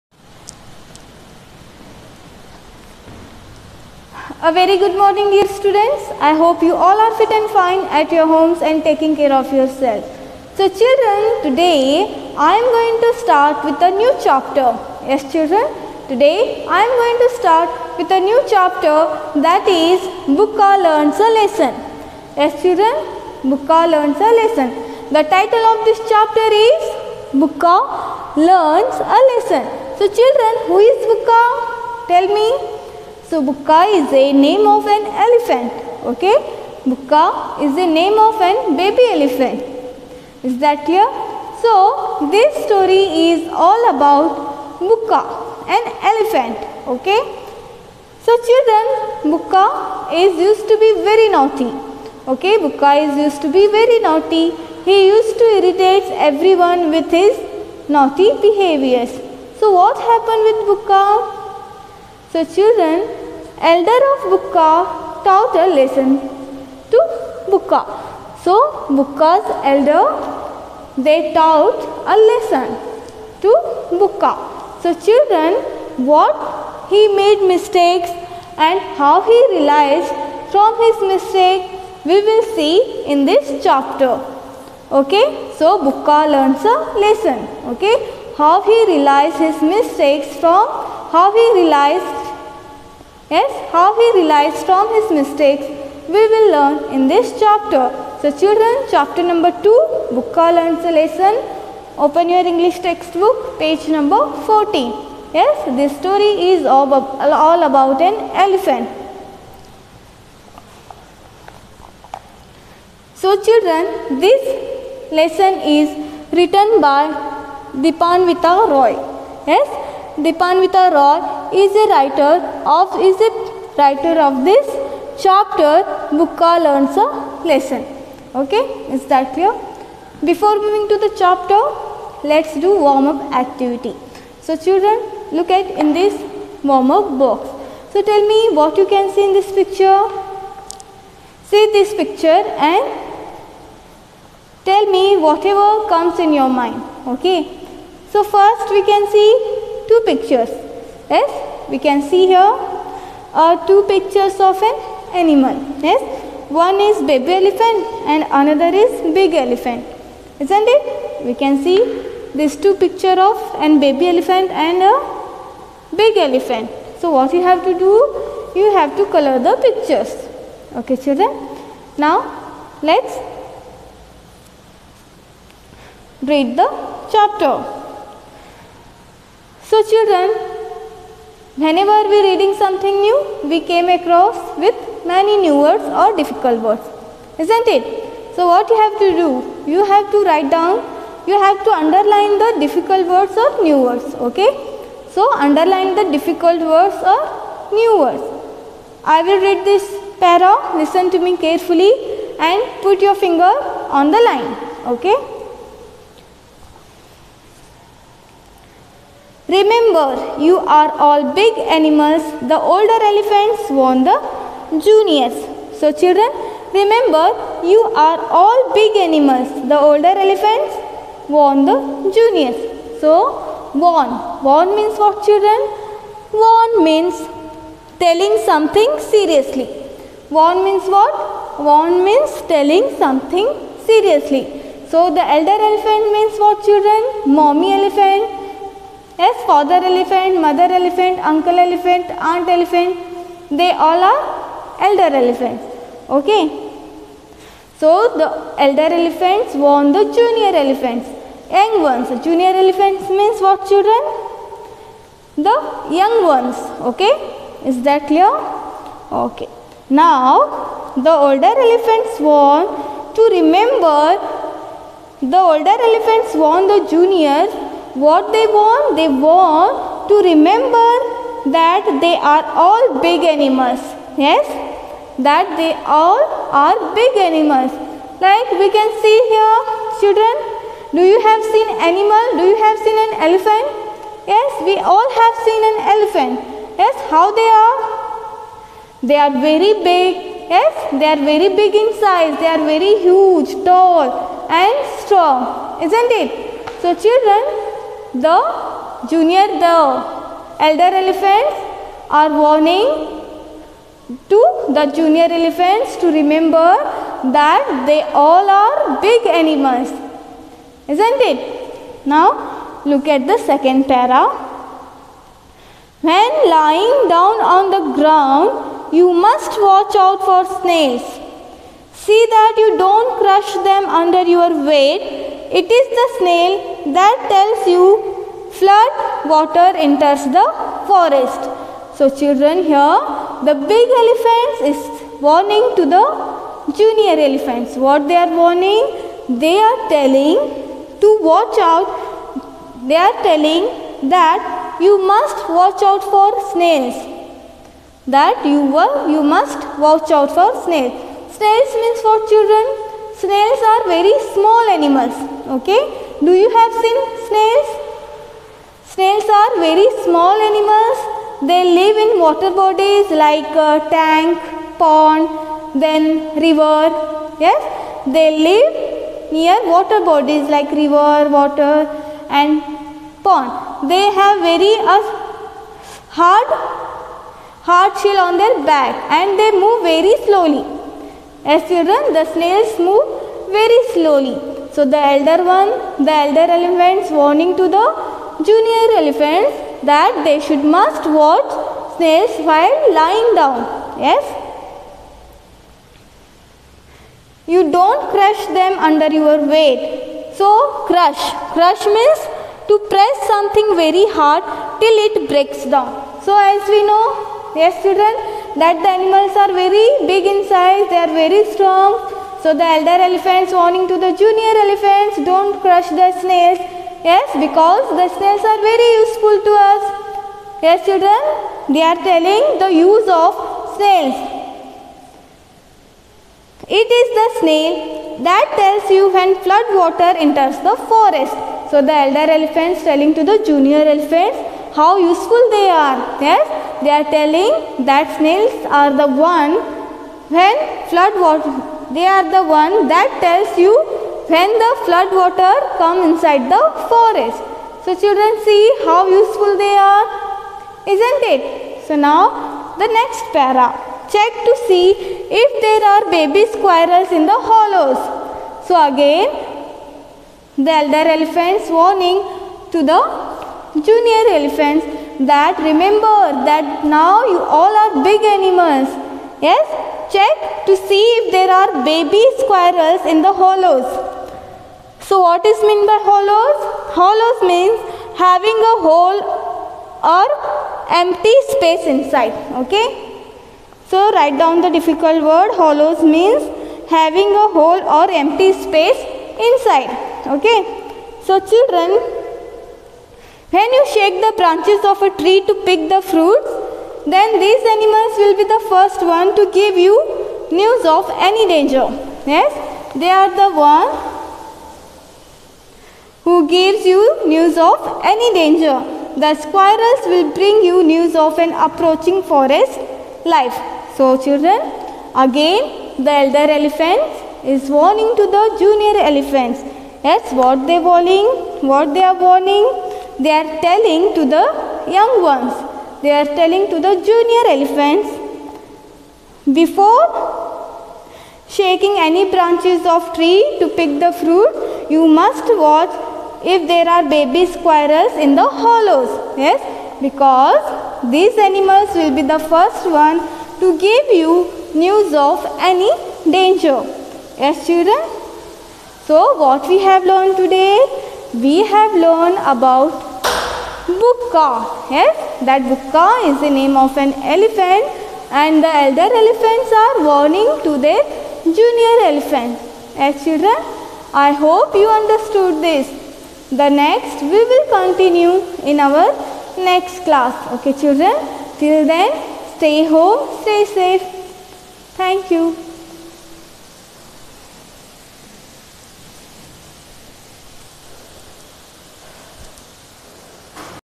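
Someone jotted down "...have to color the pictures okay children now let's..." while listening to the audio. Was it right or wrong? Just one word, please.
right.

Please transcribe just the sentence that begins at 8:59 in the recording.
Yes, because these animals will be the first one to give you news of any danger.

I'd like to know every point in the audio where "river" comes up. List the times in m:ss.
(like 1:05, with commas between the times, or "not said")
6:06, 6:10.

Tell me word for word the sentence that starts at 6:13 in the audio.
They have very uh, hard hard shell on their back and they move very slowly.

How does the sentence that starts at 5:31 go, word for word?
So children here the big elephants is warning to the junior elephants.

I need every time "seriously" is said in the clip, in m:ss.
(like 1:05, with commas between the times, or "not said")
3:48, 3:53.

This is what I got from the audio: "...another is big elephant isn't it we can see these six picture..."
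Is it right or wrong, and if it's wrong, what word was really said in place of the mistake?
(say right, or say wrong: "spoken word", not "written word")
wrong: "two", not "six".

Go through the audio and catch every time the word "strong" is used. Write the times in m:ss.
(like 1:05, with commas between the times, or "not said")
4:55, 6:51.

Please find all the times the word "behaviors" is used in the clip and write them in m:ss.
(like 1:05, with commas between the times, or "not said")
0:58.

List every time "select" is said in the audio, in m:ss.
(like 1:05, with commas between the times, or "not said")
not said.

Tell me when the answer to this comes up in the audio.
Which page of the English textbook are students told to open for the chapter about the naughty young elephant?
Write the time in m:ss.
1:43.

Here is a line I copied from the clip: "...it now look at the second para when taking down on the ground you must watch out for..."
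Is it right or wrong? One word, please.
wrong.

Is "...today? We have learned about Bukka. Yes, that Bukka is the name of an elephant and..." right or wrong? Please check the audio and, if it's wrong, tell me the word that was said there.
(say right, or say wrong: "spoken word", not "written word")
right.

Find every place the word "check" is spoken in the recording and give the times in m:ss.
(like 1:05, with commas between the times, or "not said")
7:34, 7:50.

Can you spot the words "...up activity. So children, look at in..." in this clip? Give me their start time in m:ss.
2:13.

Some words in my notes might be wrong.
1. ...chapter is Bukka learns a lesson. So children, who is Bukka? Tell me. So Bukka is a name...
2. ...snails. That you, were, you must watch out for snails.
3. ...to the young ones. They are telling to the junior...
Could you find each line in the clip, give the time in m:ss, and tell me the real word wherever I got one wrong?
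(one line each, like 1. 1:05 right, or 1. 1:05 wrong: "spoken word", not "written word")
1. 0:26 right
2. 5:46 right
3. 8:44 right.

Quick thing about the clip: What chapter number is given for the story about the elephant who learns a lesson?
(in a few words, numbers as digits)
2.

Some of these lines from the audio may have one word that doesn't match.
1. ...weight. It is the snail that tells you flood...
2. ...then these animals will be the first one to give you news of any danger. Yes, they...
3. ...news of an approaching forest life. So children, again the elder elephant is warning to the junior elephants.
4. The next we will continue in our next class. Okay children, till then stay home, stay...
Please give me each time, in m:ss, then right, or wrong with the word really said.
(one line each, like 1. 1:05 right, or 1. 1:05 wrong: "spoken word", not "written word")
1. 5:24 right
2. 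8:17 right
3. 8:30 right
4. 9:26 right.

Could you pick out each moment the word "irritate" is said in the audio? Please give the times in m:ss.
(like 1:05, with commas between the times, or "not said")
0:55.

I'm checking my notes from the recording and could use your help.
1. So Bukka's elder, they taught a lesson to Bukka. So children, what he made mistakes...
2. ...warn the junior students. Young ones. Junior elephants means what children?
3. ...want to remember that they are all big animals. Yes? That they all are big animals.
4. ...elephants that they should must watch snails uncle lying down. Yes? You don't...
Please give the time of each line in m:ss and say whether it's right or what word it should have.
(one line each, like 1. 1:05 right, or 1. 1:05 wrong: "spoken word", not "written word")
1. 1:08 right
2. 4:09 wrong: "elephants", not "students"
3. 4:29 right
4. 6:29 wrong: "while", not "uncle".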